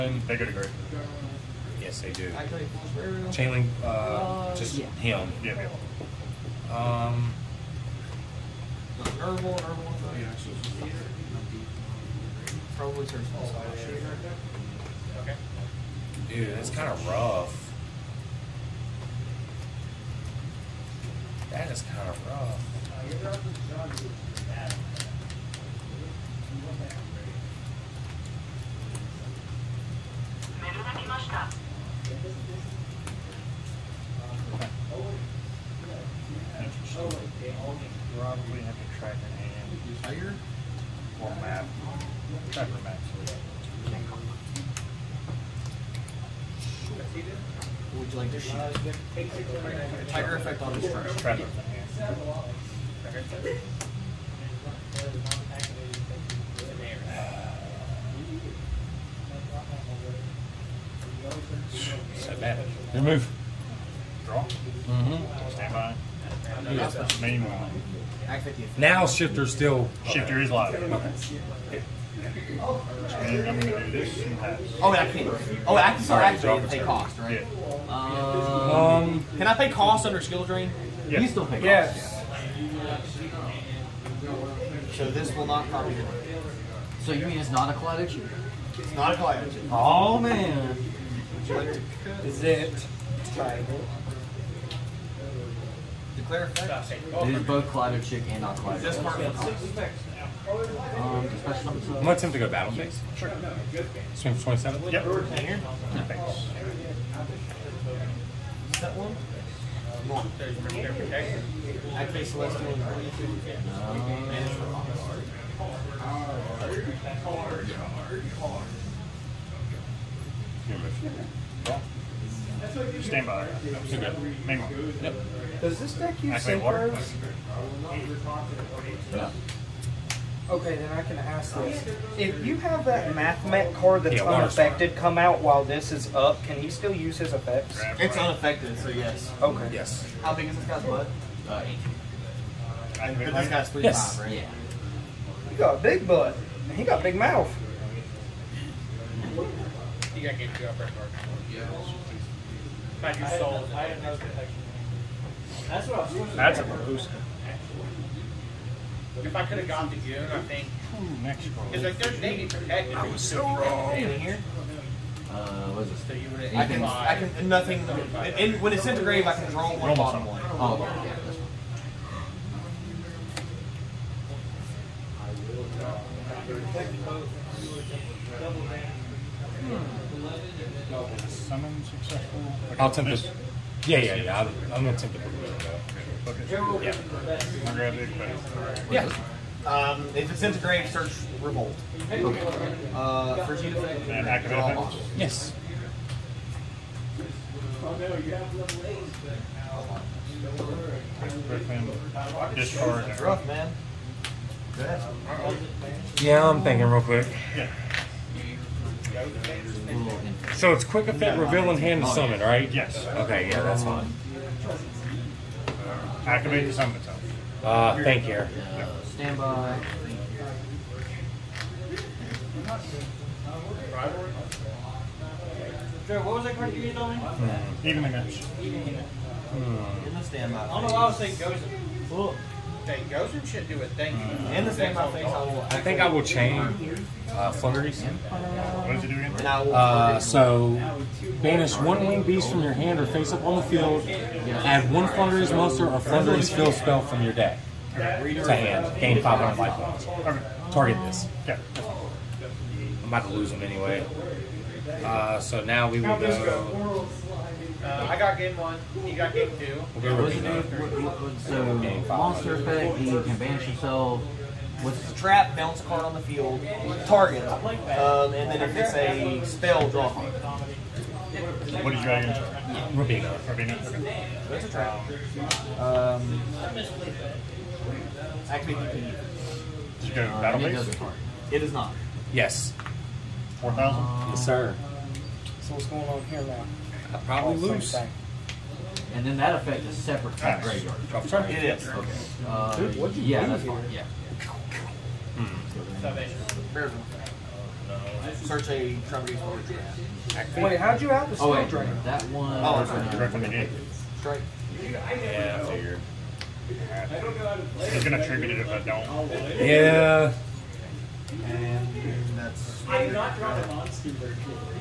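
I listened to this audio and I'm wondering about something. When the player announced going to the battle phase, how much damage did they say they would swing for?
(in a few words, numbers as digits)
27.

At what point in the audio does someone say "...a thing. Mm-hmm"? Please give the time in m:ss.
3:53.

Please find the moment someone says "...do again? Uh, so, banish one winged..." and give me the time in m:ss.
3:59.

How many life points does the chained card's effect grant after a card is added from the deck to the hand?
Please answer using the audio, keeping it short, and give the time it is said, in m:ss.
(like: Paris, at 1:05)
500, at 4:09.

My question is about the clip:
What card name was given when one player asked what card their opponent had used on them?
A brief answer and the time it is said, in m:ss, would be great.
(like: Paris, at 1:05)
Evening Match, at 3:47.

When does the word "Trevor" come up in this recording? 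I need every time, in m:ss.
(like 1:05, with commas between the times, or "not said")
0:42, 0:51.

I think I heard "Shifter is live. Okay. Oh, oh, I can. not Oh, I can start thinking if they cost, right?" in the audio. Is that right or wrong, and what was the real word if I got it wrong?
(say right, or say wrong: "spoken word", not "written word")
wrong: "activating", not "thinking".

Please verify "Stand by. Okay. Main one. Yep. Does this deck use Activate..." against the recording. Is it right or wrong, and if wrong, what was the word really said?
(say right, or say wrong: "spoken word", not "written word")
right.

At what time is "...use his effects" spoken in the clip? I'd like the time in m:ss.
2:16.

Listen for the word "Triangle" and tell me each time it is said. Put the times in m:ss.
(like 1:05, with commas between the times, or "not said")
1:33.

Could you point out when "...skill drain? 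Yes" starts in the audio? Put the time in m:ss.
1:20.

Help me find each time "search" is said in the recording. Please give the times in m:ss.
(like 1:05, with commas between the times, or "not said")
3:10, 4:58.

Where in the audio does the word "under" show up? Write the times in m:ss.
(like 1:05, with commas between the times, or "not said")
1:20.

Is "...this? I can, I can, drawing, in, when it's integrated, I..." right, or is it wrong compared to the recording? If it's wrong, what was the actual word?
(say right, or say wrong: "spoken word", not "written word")
wrong: "nothing", not "drawing".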